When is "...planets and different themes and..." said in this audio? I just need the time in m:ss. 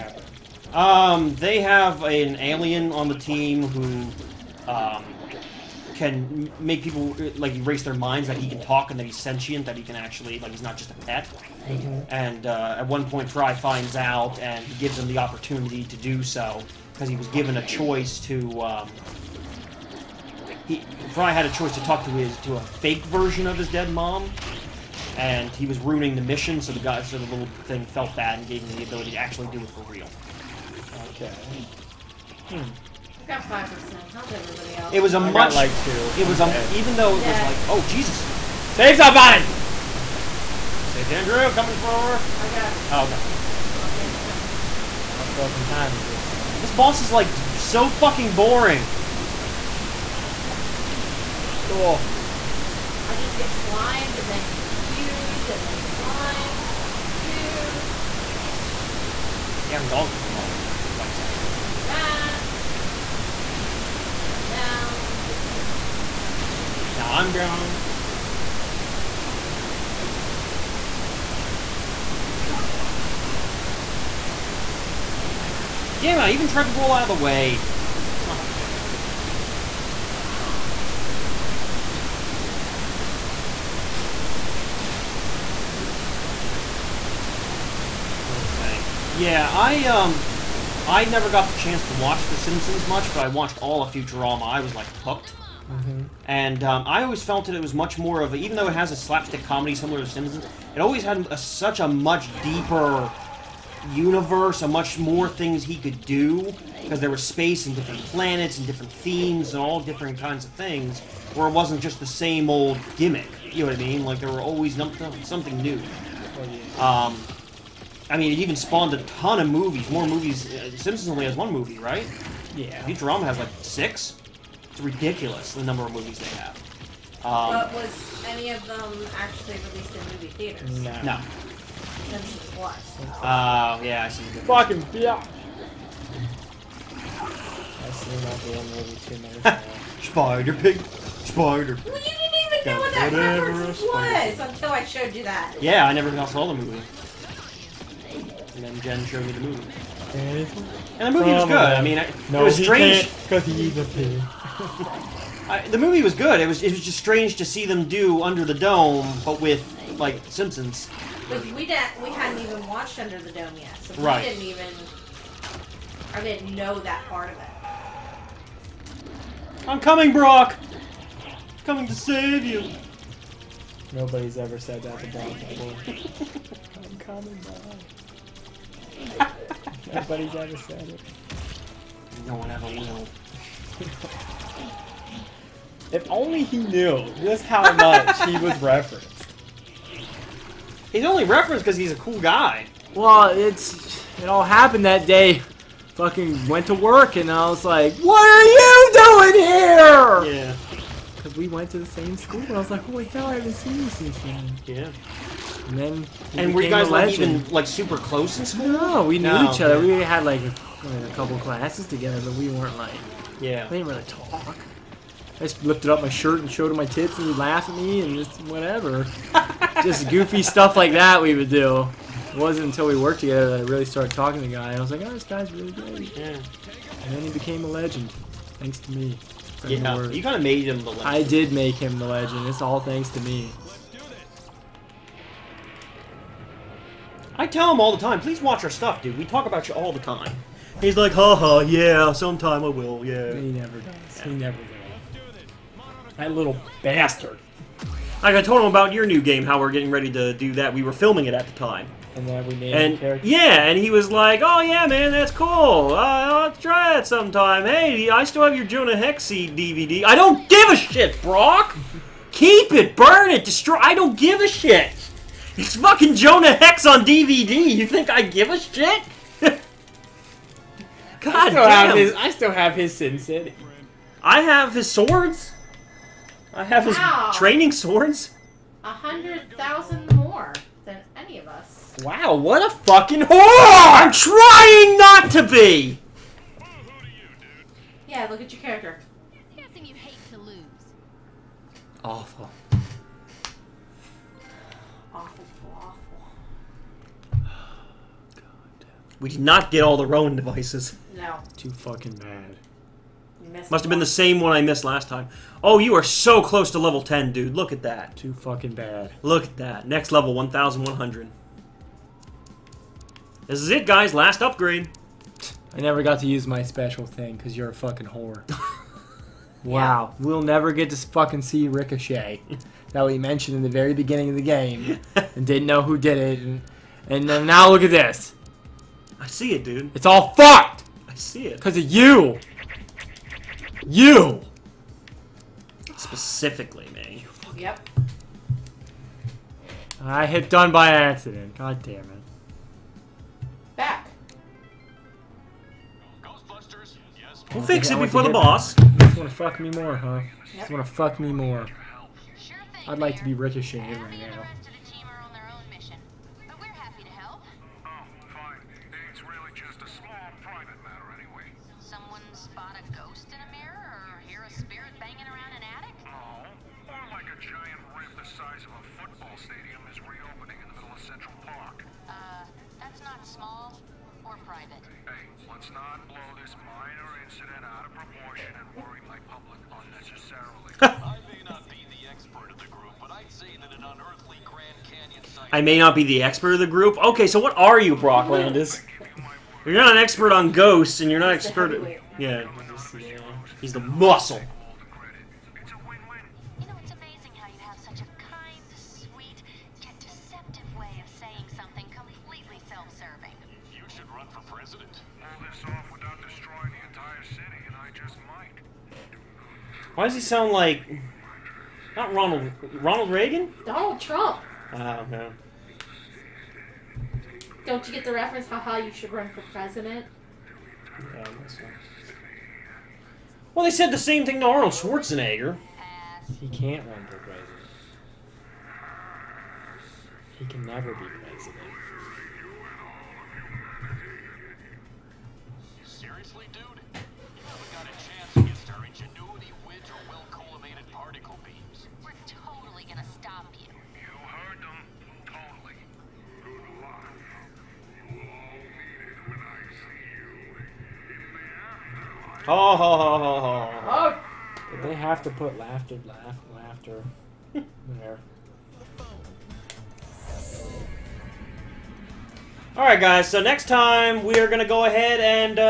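1:48.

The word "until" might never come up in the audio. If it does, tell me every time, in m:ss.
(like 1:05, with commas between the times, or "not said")
2:24, 3:42.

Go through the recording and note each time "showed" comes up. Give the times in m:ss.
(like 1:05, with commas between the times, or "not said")
2:24, 2:29, 3:36.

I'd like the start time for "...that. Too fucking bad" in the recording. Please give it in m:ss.
5:07.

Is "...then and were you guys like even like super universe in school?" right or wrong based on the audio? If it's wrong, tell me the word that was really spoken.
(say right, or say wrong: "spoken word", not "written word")
wrong: "close", not "universe".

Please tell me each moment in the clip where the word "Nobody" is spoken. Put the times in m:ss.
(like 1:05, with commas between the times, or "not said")
2:53, 2:59.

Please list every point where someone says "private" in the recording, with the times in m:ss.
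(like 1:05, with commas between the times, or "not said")
6:00, 6:14.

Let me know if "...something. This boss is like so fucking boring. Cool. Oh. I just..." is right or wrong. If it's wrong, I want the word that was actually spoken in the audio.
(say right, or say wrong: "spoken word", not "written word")
right.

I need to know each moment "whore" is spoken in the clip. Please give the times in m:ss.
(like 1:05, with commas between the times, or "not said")
4:43, 5:18.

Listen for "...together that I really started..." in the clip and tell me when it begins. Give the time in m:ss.
3:43.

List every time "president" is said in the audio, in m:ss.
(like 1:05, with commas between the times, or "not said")
6:44, 6:59, 7:07, 7:11.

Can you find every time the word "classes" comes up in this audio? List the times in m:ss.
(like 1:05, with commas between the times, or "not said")
3:31.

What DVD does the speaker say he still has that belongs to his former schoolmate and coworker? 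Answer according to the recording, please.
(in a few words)
Jonah Hex.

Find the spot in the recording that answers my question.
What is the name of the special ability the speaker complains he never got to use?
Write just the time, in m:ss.
5:21.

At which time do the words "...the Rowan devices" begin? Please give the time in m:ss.
4:59.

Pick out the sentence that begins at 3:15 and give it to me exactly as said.
Fucking went to work and I was like, "What are you doing here?" Yeah.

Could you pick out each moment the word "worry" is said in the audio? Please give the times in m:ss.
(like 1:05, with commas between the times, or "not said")
6:18.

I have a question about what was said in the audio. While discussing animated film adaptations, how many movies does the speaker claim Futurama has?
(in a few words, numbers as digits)
6.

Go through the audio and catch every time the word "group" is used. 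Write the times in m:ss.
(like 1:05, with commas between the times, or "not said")
6:22, 6:26.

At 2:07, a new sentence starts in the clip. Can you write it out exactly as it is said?
Um, but was any of them actually released in movie theaters?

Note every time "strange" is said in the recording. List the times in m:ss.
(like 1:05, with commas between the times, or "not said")
2:32, 2:36.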